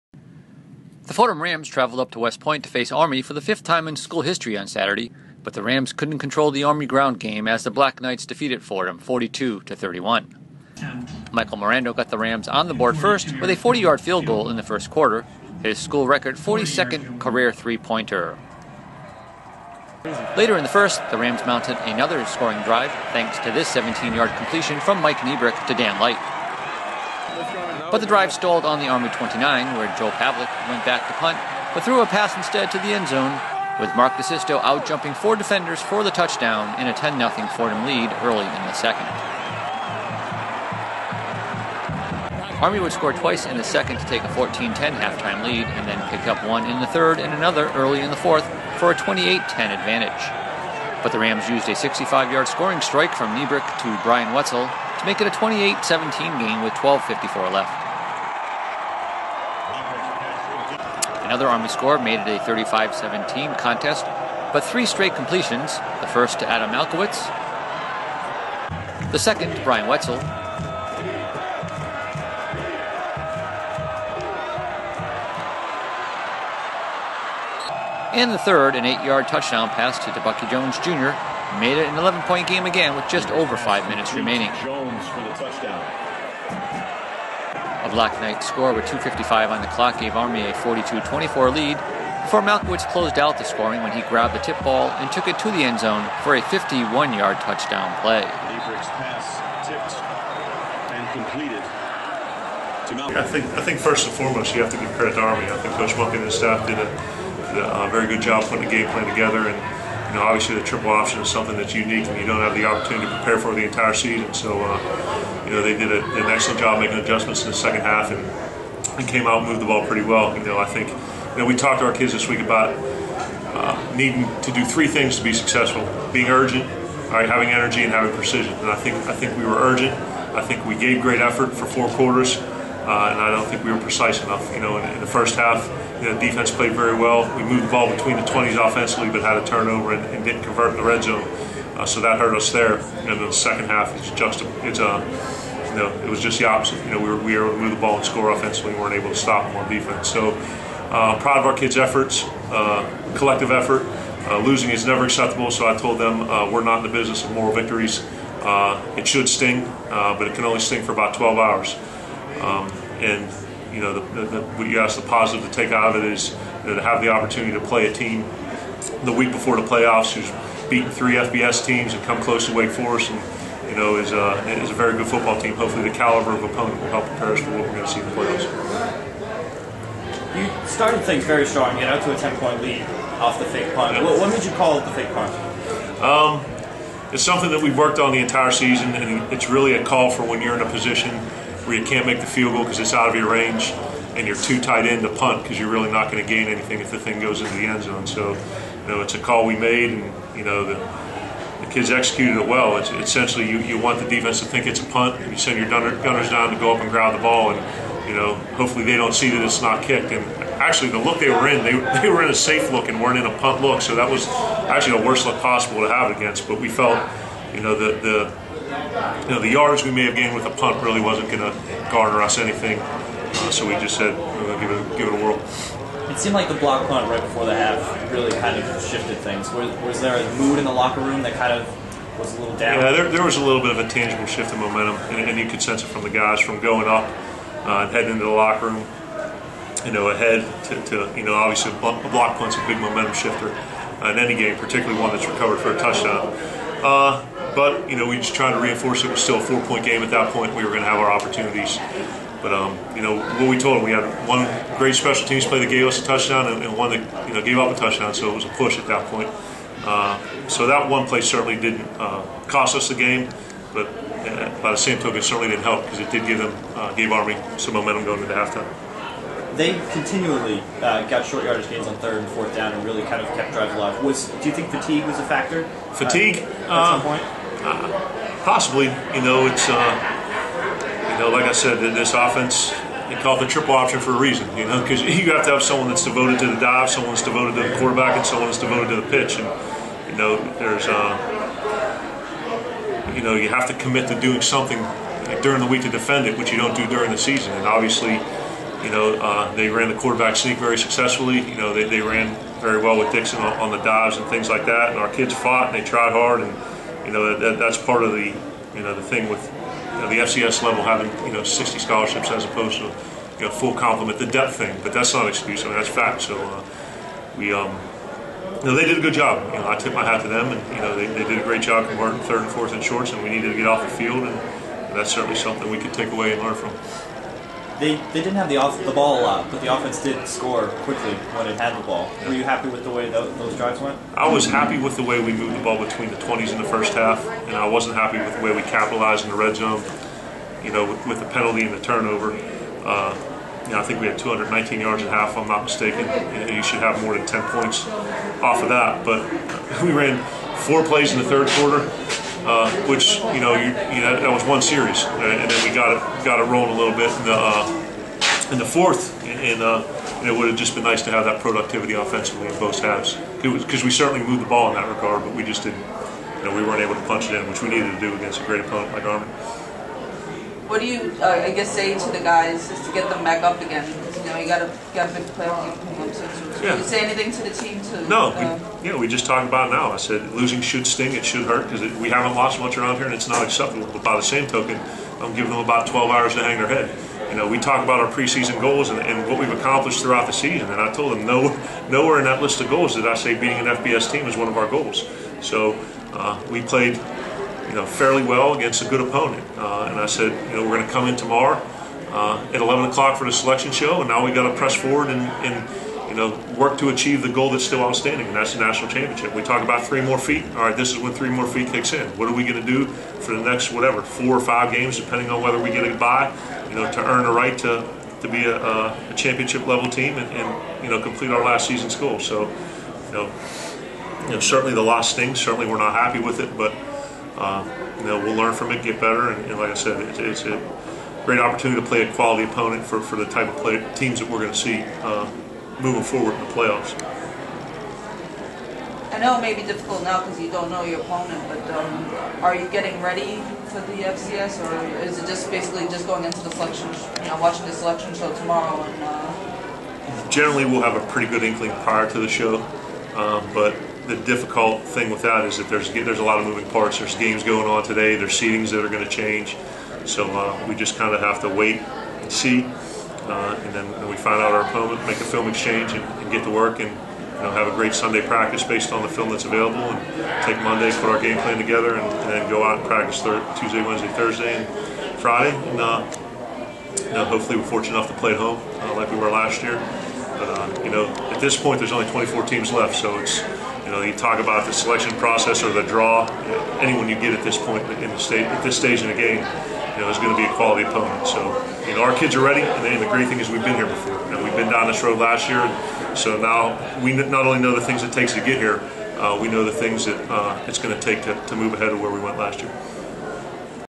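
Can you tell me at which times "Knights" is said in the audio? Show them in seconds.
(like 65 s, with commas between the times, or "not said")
7 s, 88 s.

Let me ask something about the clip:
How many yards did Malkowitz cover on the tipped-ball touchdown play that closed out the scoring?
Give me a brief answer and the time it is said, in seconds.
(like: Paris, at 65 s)
51, at 96 s.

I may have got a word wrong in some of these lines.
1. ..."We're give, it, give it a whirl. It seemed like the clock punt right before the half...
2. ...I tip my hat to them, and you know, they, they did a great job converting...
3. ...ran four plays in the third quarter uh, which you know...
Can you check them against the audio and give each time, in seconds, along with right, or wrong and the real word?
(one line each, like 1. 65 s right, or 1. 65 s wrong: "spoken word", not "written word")
1. 224 s wrong: "block", not "clock"
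2. 319 s right
3. 349 s right.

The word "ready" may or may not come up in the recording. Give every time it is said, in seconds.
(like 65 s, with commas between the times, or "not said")
443 s, 492 s.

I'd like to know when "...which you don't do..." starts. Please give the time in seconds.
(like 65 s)
296 s.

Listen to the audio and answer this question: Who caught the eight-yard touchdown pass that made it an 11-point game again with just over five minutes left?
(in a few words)
Bucky Jones Jr.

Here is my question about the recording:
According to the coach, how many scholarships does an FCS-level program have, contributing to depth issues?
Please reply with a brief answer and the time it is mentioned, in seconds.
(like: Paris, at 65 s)
60, at 311 s.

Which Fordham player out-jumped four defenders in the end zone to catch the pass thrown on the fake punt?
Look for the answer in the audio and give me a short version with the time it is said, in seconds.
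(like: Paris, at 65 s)
Mark DeSisto, at 33 s.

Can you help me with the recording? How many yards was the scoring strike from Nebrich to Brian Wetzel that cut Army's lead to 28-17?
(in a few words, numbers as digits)
65.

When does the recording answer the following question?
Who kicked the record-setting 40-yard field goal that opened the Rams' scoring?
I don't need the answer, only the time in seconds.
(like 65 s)
11 s.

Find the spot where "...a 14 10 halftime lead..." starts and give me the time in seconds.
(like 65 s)
44 s.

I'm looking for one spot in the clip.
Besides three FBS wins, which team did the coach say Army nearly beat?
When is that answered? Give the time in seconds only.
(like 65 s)
172 s.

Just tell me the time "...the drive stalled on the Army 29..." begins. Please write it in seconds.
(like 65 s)
27 s.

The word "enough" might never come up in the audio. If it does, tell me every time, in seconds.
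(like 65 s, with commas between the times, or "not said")
134 s, 477 s.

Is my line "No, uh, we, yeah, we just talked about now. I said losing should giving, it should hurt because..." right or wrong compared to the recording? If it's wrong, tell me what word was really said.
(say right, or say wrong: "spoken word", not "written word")
wrong: "sting", not "giving".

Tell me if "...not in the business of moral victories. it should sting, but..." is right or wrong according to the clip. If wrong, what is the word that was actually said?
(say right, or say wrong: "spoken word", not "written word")
right.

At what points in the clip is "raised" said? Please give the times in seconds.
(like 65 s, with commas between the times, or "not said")
not said.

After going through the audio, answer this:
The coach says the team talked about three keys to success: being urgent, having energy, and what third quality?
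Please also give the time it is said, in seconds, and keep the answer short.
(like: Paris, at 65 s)
Precision, at 127 s.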